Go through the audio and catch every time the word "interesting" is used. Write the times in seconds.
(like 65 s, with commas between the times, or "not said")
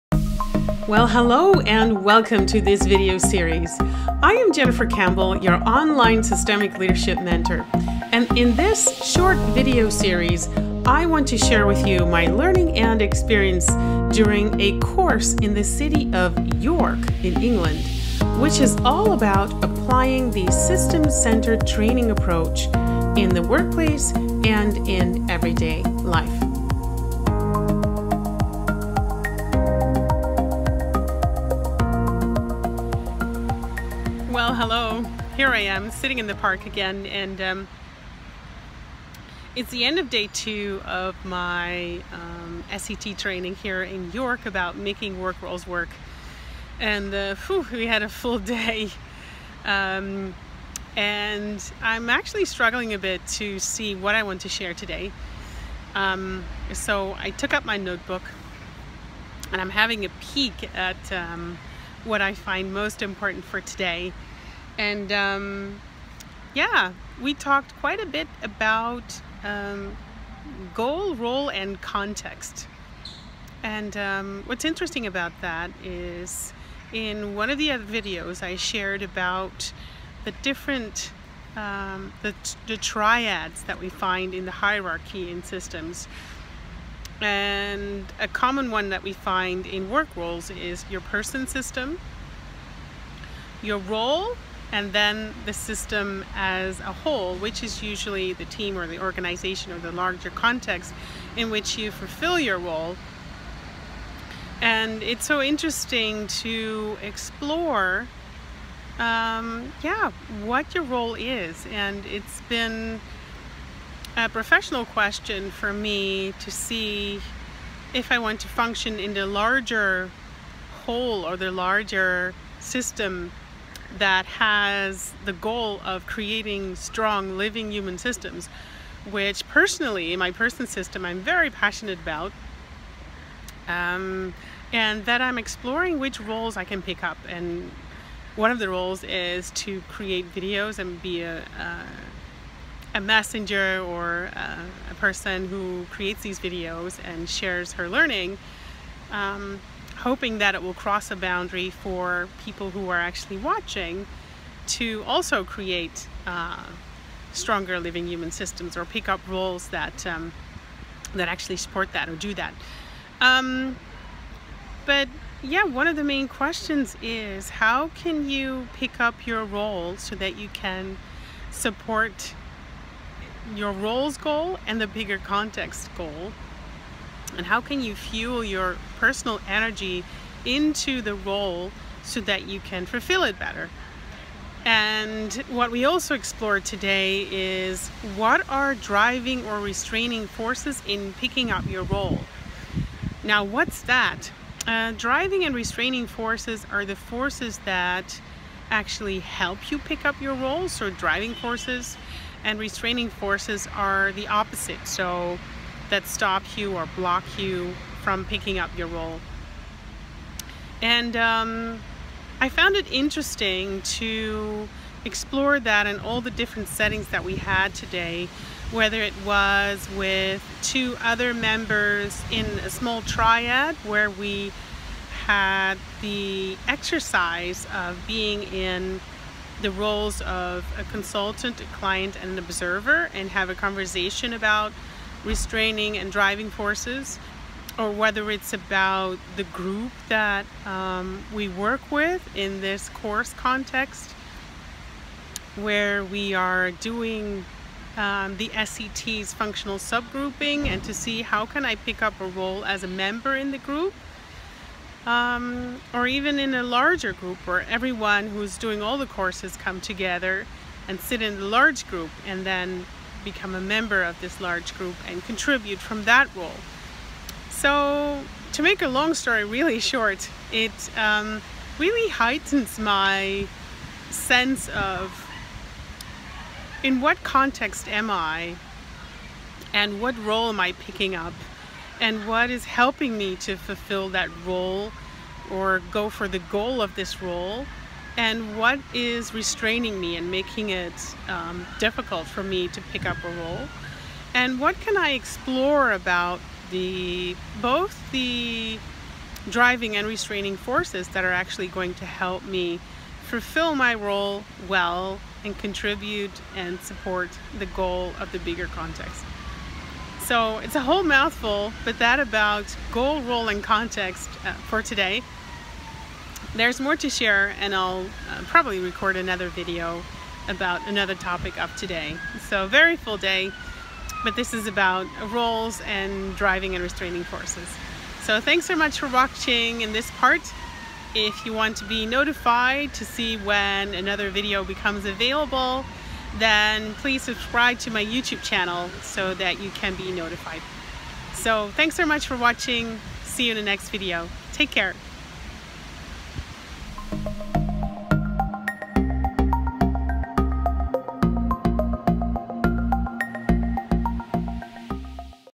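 74 s, 105 s, 212 s.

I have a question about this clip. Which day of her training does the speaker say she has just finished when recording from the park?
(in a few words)
Day two.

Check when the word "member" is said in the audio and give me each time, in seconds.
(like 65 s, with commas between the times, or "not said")
221 s, 252 s, 263 s.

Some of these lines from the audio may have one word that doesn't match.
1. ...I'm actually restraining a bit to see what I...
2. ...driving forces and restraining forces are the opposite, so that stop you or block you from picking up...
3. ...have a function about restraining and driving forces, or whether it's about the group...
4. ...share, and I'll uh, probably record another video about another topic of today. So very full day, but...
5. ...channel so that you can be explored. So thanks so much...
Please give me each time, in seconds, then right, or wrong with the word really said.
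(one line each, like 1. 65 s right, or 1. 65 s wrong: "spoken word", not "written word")
1. 51 s wrong: "struggling", not "restraining"
2. 200 s right
3. 233 s wrong: "conversation", not "function"
4. 317 s right
5. 338 s wrong: "notified", not "explored".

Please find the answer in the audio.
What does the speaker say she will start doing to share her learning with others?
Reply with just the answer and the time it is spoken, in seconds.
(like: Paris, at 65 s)
Create videos, at 139 s.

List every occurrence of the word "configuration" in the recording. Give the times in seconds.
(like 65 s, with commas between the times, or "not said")
not said.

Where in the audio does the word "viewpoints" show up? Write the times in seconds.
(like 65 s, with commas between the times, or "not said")
not said.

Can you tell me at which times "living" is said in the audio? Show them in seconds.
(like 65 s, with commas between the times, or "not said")
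127 s, 157 s.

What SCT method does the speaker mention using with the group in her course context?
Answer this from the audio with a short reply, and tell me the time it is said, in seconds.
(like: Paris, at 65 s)
Functional subgrouping, at 249 s.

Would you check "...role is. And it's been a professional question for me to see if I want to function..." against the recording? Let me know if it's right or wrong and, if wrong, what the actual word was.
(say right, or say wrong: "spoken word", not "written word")
right.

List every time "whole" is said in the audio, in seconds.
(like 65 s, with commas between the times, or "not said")
96 s, 120 s, 310 s.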